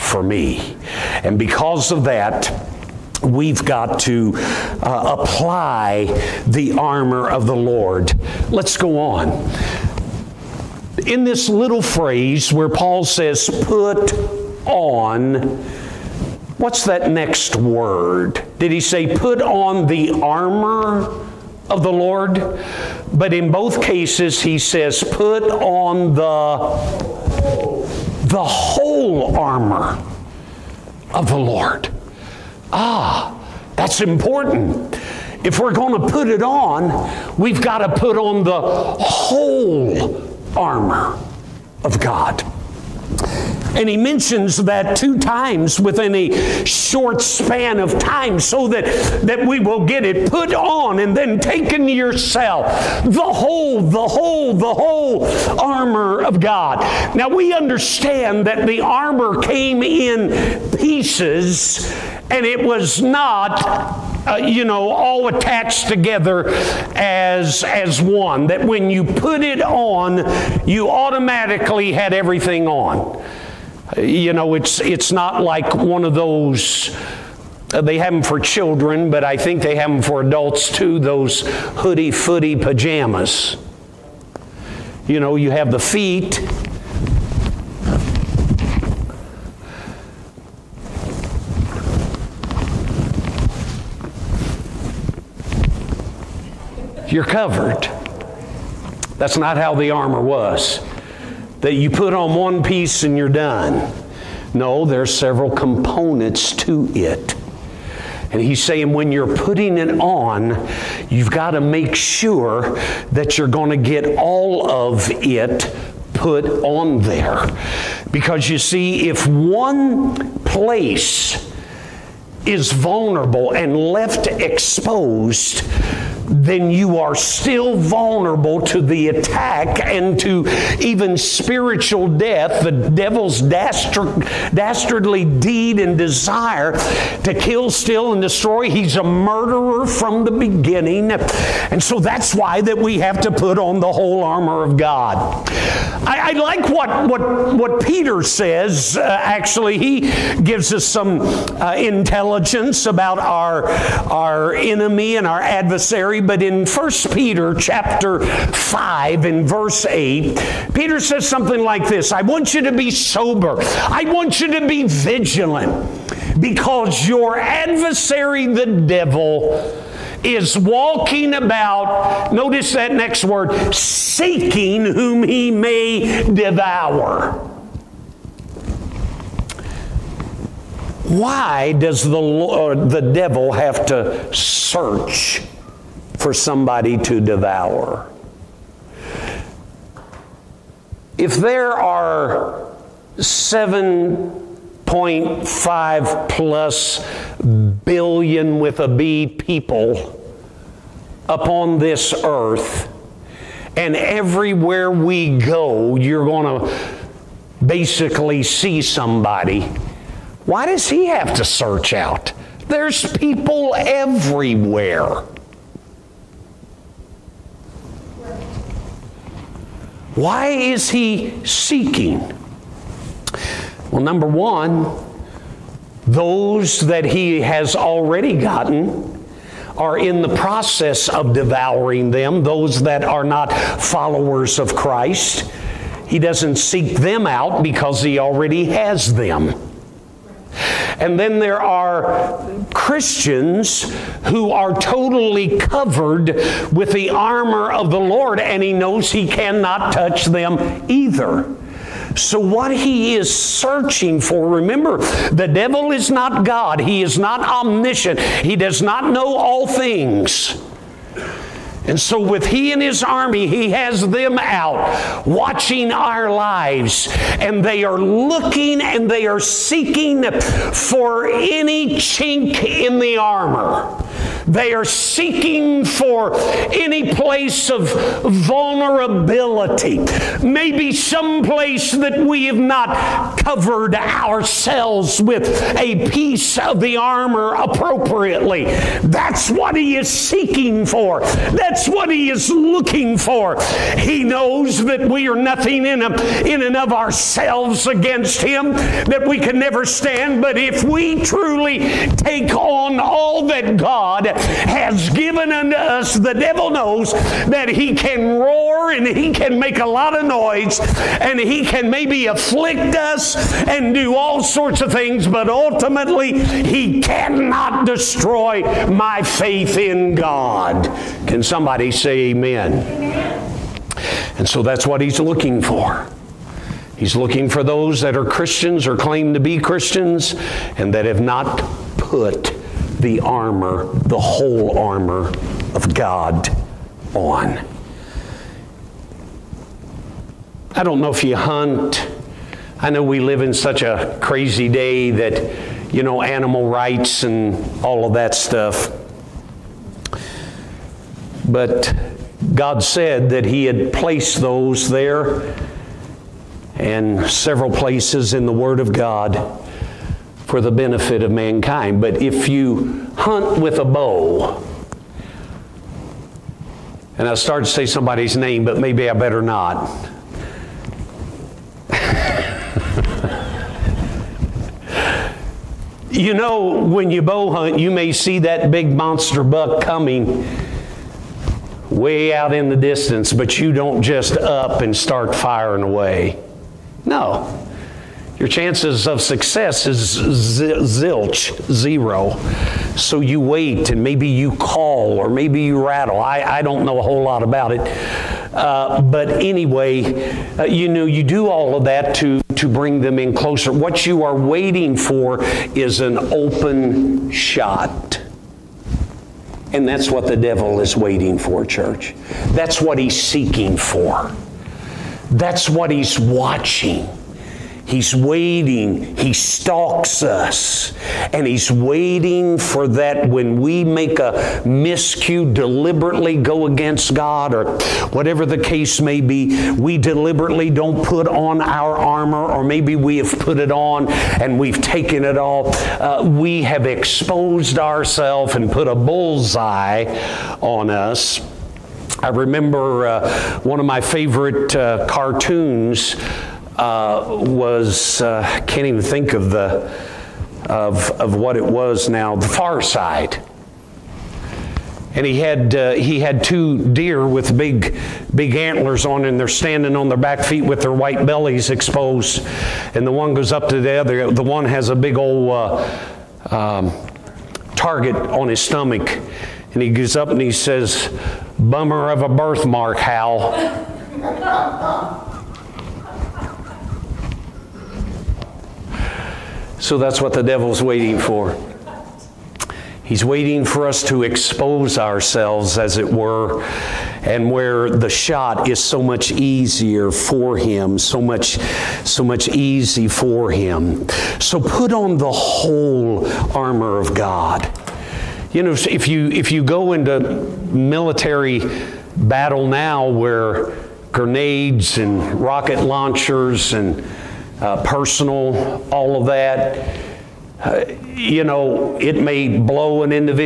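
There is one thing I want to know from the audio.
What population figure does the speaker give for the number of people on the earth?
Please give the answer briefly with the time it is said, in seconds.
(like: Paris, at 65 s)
7.5 billion, at 193 s.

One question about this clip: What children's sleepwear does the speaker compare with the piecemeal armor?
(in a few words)
hoodie footy pajamas.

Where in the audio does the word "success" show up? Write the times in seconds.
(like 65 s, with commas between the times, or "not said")
389 s.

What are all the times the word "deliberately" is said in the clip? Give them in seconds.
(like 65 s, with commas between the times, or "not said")
425 s, 429 s.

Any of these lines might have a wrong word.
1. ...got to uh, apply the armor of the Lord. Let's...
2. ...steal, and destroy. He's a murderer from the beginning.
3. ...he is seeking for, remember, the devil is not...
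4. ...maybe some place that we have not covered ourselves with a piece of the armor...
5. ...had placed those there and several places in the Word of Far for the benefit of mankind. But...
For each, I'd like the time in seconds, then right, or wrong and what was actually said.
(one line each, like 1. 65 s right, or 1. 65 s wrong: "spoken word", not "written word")
1. 3 s right
2. 137 s right
3. 252 s wrong: "searching", not "seeking"
4. 280 s right
5. 353 s wrong: "God", not "Far".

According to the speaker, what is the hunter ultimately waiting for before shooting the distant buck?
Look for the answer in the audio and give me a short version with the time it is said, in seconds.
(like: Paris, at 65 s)
an open shot, at 406 s.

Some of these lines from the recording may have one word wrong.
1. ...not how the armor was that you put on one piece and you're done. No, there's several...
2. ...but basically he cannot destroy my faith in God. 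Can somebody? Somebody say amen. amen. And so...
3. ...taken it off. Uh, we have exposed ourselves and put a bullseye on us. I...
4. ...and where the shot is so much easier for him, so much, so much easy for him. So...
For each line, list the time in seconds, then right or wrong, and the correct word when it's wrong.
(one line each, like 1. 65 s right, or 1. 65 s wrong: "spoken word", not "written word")
1. 99 s right
2. 315 s wrong: "ultimately", not "basically"
3. 434 s right
4. 487 s right.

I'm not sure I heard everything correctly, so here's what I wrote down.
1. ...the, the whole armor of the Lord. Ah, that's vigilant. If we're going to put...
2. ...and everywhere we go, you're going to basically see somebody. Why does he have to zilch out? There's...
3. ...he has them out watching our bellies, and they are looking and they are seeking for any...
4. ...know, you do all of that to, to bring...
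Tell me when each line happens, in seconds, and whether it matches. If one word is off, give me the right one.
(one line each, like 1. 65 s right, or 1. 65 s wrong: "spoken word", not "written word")
1. 26 s wrong: "important", not "vigilant"
2. 203 s wrong: "search", not "zilch"
3. 263 s wrong: "lives", not "bellies"
4. 400 s right.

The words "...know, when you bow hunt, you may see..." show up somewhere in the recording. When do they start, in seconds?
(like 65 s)
376 s.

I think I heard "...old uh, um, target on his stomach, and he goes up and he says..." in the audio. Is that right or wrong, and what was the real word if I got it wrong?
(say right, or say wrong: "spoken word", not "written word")
right.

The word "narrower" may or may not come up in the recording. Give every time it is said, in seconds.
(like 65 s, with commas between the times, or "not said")
not said.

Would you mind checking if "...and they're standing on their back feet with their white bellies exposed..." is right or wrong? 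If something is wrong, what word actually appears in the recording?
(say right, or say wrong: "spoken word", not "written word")
right.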